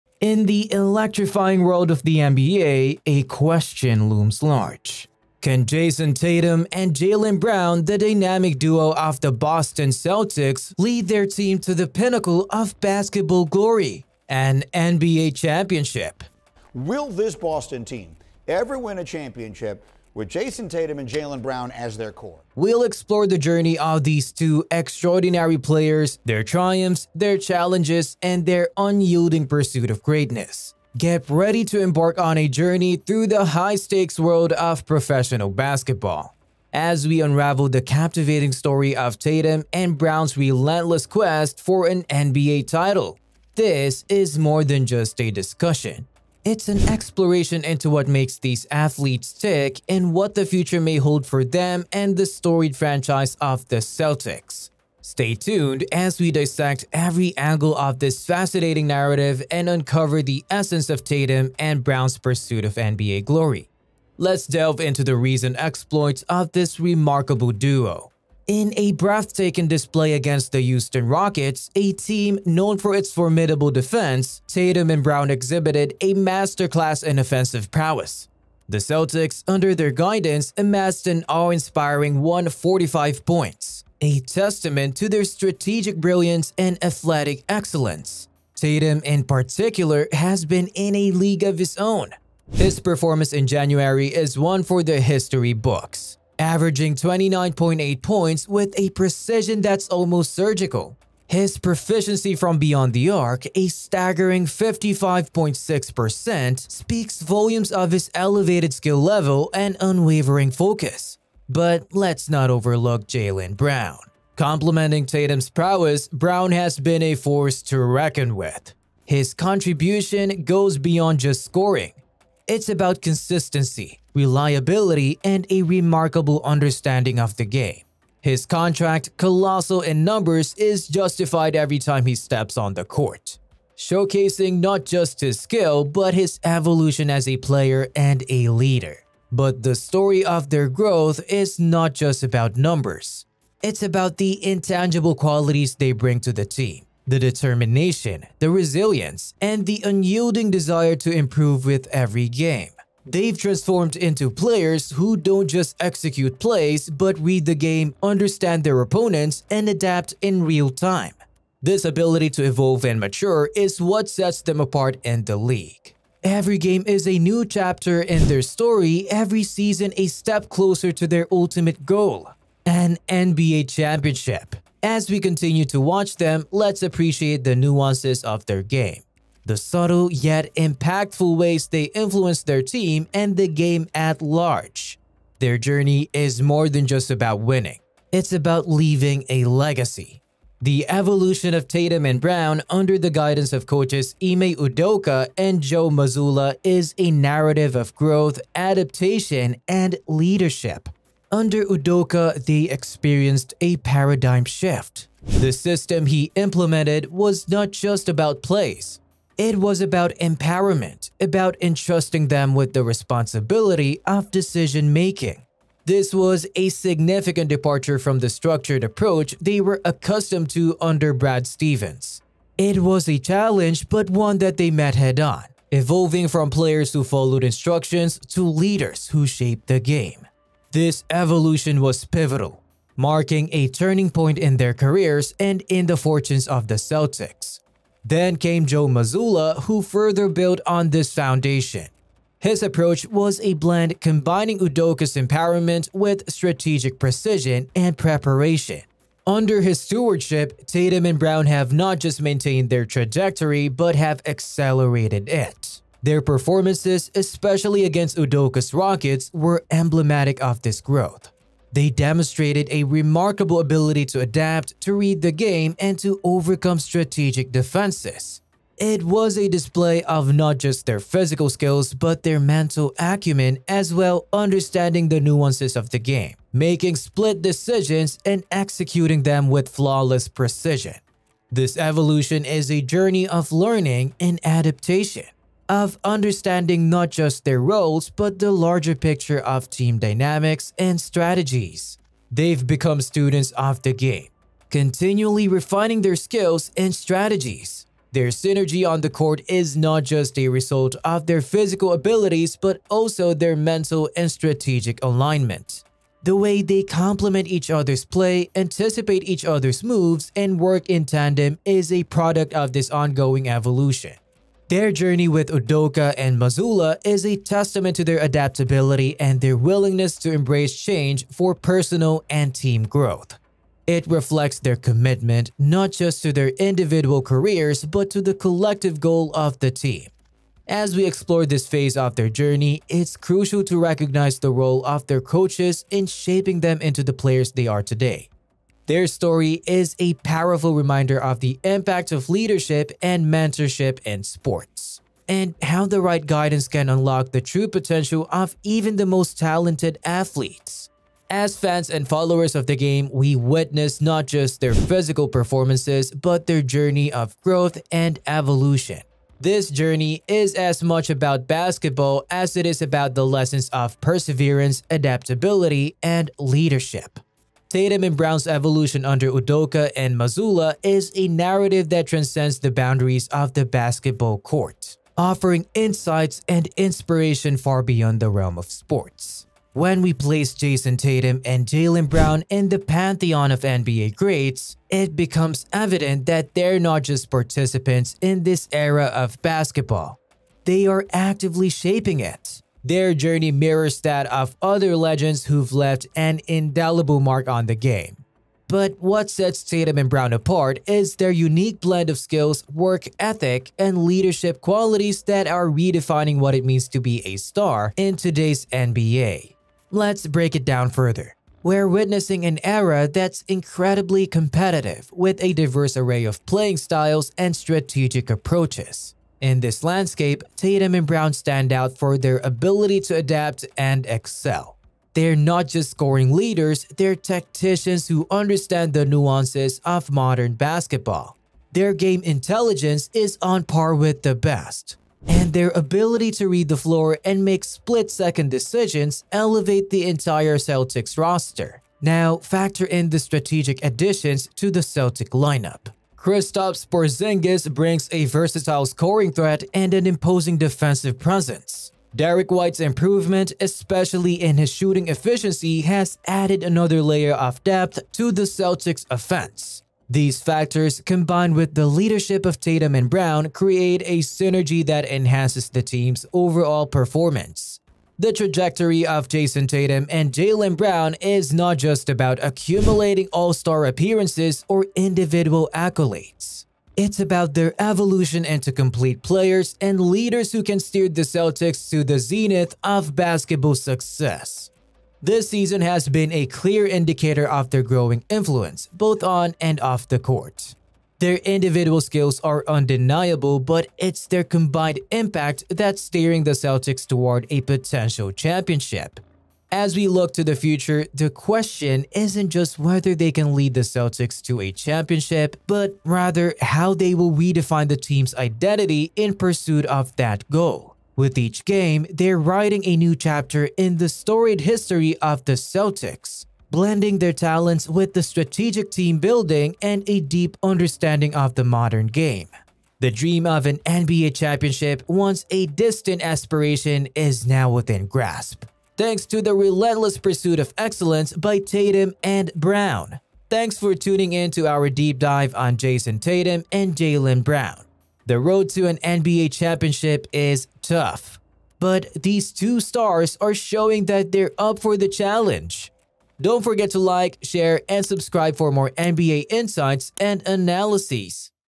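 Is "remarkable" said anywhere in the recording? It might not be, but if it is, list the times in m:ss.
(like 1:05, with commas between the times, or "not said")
1:06, 2:05, 4:22.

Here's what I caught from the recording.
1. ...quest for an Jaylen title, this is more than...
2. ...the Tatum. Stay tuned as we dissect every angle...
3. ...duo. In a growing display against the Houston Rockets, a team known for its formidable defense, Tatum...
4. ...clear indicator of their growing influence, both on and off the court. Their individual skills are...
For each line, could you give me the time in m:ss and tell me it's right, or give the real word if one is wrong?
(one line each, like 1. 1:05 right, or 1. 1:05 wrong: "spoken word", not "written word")
1. 0:41 wrong: "NBA", not "Jaylen"
2. 0:53 wrong: "Celtics", not "Tatum"
3. 1:07 wrong: "breathtaking", not "growing"
4. 8:06 right.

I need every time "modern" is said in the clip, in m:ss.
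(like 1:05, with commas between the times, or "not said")
7:10, 8:41.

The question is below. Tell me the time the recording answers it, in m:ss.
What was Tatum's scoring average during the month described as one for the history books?
1:36.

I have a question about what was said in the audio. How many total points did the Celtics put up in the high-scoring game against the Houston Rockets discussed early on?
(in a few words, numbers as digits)
145.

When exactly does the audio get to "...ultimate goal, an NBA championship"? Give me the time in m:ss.
2:51.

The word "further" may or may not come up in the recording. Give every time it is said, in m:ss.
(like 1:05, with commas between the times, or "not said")
3:59, 6:50.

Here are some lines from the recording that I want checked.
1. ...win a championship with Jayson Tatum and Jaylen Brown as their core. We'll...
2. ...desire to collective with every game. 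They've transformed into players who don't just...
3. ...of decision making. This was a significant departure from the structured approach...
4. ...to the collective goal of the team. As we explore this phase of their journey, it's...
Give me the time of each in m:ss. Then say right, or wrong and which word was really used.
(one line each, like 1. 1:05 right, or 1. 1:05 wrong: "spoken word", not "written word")
1. 0:18 right
2. 2:30 wrong: "improve", not "collective"
3. 3:34 right
4. 5:28 right.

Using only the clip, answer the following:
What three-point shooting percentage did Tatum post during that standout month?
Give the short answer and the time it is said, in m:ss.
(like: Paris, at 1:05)
55.6%, at 1:44.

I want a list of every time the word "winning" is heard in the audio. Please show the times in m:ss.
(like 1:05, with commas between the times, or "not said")
3:07.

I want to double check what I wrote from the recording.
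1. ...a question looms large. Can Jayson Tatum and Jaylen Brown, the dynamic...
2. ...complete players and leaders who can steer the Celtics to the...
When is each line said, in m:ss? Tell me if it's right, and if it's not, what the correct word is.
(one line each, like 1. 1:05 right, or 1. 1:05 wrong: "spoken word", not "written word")
1. 0:03 right
2. 7:58 right.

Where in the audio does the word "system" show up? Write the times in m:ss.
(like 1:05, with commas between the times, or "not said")
3:25.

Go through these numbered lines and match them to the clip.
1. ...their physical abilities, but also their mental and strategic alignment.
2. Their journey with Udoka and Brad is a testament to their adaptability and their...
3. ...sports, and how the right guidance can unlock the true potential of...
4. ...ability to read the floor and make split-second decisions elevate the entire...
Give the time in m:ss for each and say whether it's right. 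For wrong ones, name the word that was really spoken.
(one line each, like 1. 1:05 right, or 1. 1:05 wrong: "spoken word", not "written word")
1. 5:01 right
2. 5:14 wrong: "Mazzulla", not "Brad"
3. 5:44 right
4. 7:15 right.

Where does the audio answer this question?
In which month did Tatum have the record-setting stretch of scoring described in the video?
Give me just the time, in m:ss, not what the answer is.
1:33.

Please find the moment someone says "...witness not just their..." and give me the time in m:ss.
5:53.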